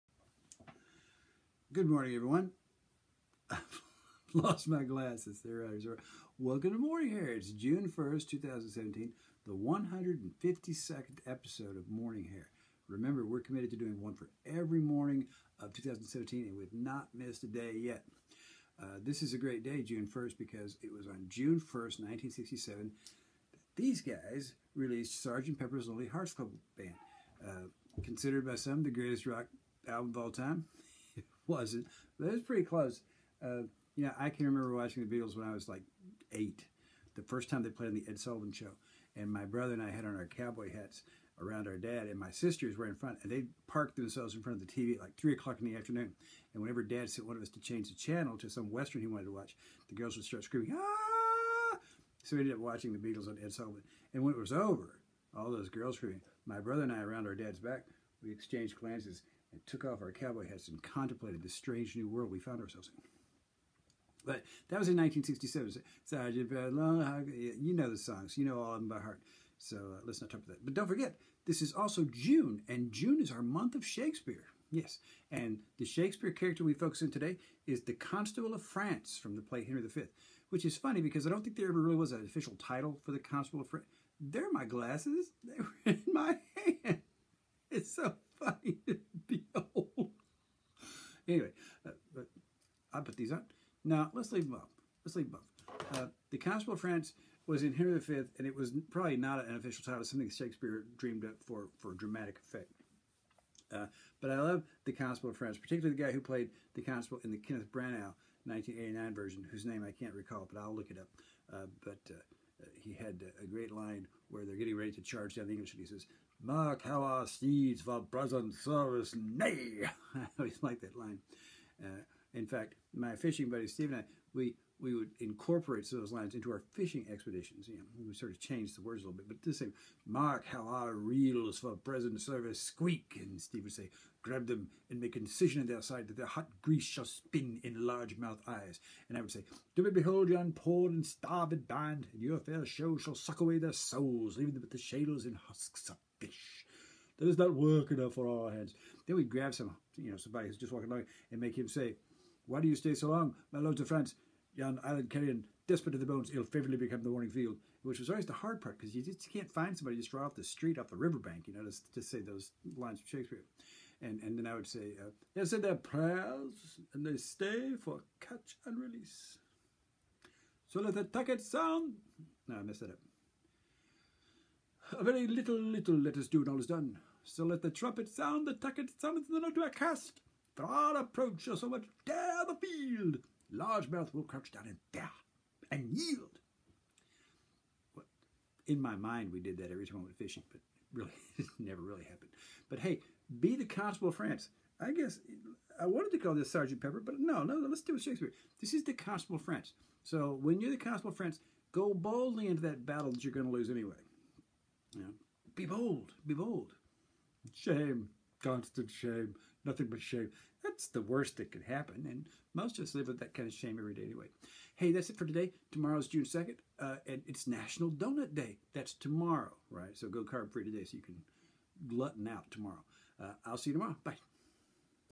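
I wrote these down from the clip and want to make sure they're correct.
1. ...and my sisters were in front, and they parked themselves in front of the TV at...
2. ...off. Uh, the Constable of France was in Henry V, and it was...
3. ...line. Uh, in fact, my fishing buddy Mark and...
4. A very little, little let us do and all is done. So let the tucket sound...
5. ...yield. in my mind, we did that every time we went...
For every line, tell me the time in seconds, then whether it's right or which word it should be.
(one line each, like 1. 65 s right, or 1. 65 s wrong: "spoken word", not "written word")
1. 42 s right
2. 95 s right
3. 120 s wrong: "Steve", not "Mark"
4. 174 s wrong: "trumpet", not "tucket"
5. 185 s right.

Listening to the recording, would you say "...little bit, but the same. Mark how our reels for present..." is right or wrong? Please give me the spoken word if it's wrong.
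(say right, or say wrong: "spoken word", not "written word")
right.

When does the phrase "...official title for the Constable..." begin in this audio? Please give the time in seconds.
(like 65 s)
82 s.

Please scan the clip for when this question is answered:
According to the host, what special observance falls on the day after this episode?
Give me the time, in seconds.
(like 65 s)
217 s.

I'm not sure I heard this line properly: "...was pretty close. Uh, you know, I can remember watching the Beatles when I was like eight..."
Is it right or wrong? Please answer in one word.
right.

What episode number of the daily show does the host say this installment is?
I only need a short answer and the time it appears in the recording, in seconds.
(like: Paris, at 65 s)
152nd, at 9 s.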